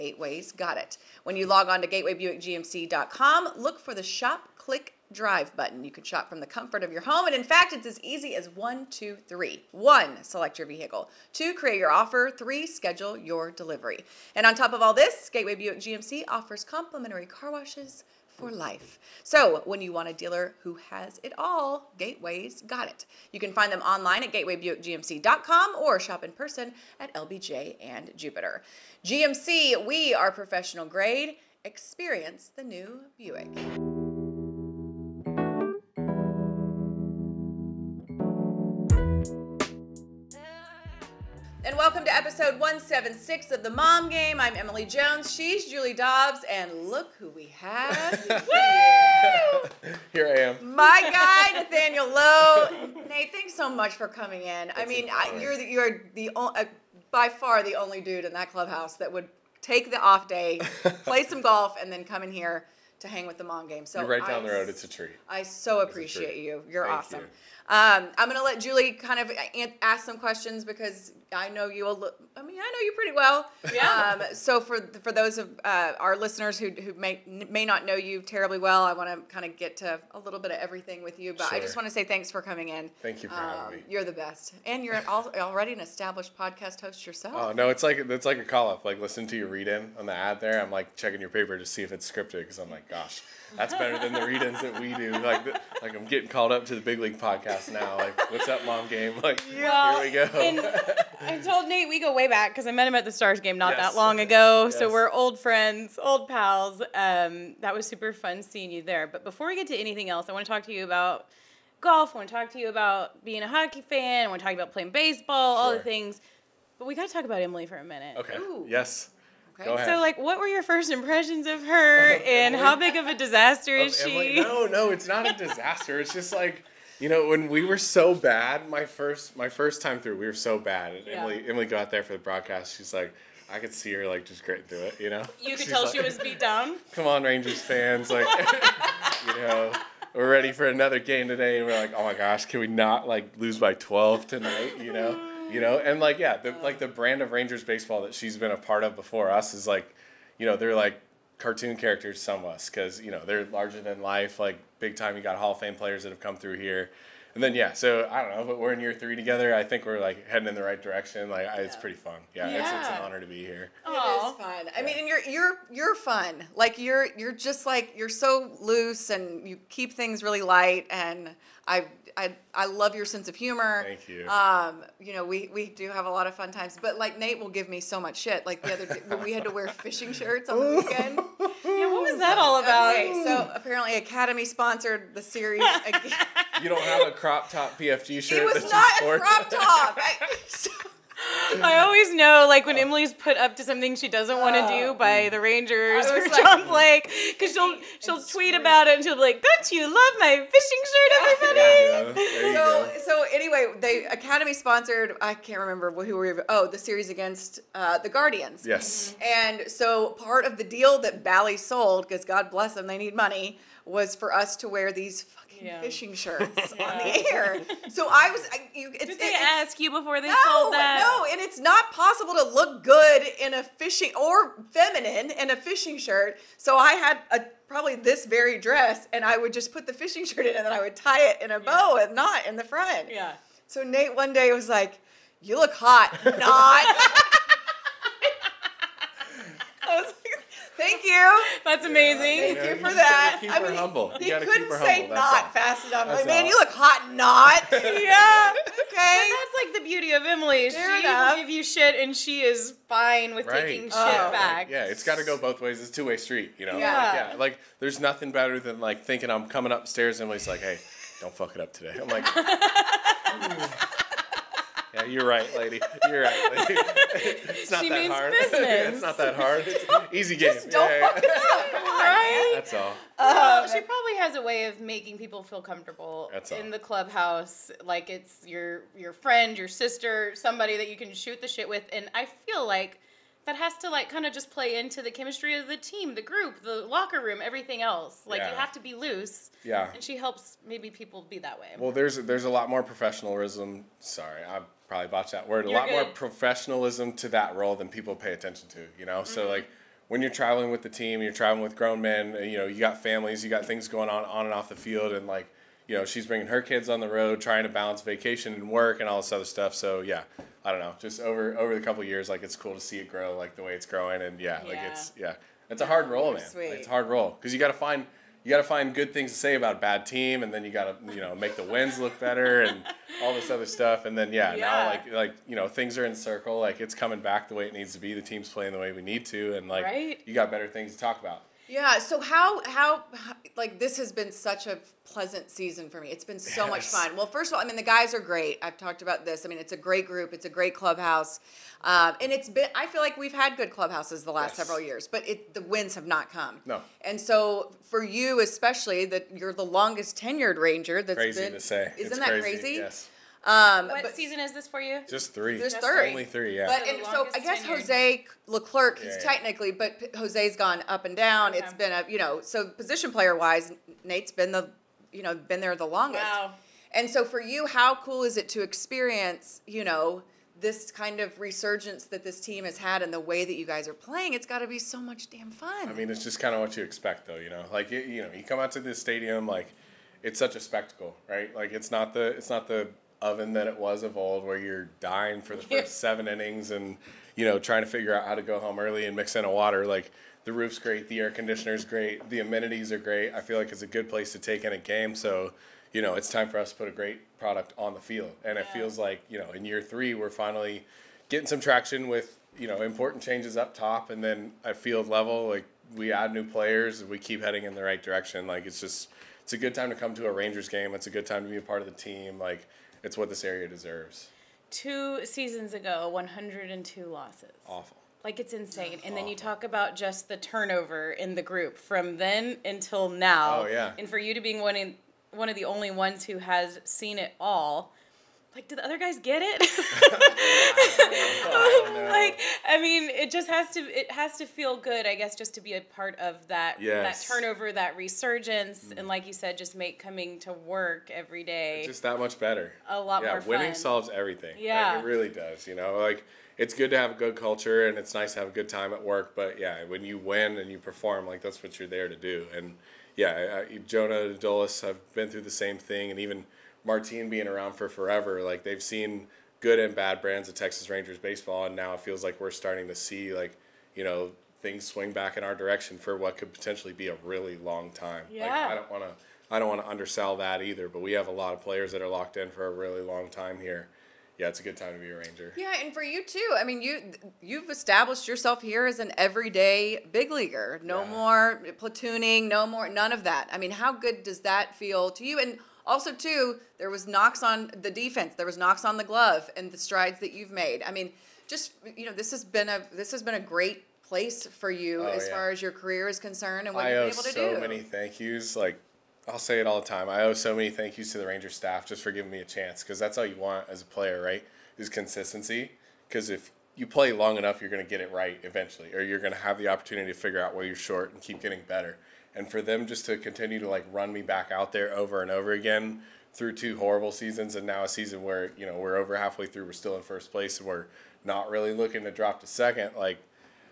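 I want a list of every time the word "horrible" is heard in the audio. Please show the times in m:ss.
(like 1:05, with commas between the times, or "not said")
8:36.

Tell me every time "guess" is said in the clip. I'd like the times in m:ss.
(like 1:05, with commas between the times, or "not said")
5:57, 7:15.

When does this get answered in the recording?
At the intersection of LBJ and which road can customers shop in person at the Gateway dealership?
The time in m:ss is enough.
0:28.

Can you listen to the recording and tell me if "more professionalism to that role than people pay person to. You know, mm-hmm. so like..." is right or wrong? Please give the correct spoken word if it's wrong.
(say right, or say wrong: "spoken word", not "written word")
wrong: "attention", not "person".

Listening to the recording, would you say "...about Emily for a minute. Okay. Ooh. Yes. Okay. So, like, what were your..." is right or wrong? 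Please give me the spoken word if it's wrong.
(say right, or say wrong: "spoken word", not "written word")
right.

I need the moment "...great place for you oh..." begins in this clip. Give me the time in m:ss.
8:13.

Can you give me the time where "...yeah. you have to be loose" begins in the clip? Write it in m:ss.
4:48.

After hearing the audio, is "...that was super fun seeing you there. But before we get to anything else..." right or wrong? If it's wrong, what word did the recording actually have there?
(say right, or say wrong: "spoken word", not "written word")
right.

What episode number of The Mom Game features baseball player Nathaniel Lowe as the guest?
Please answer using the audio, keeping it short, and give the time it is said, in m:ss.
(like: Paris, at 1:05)
176, at 0:42.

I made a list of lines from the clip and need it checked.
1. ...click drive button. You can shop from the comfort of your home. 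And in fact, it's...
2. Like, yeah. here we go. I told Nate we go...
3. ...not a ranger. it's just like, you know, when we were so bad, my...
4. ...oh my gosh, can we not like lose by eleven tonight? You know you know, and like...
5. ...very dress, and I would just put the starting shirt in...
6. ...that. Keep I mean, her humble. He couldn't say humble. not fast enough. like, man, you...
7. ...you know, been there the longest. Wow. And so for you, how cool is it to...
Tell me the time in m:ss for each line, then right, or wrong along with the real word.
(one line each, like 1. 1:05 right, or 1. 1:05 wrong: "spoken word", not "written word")
1. 0:04 right
2. 1:39 right
3. 2:05 wrong: "disaster", not "ranger"
4. 2:21 wrong: "twelve", not "eleven"
5. 3:48 wrong: "fishing", not "starting"
6. 4:02 right
7. 6:05 right.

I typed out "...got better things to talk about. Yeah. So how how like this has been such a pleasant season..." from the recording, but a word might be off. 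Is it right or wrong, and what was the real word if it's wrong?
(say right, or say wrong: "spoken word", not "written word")
right.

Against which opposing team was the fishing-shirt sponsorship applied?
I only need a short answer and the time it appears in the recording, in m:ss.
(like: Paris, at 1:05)
Guardians, at 3:28.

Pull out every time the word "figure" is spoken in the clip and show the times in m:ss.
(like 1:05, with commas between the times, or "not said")
6:27, 8:30.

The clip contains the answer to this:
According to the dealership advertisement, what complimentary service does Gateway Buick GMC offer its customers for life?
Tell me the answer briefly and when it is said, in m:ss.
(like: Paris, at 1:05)
Car washes, at 0:17.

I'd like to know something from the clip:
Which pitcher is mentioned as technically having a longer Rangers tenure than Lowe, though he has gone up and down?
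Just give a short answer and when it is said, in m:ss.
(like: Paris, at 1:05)
Jose Leclerc, at 5:57.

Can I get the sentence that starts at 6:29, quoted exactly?
Like the roof's great, the air conditioner's great, the amenities are great.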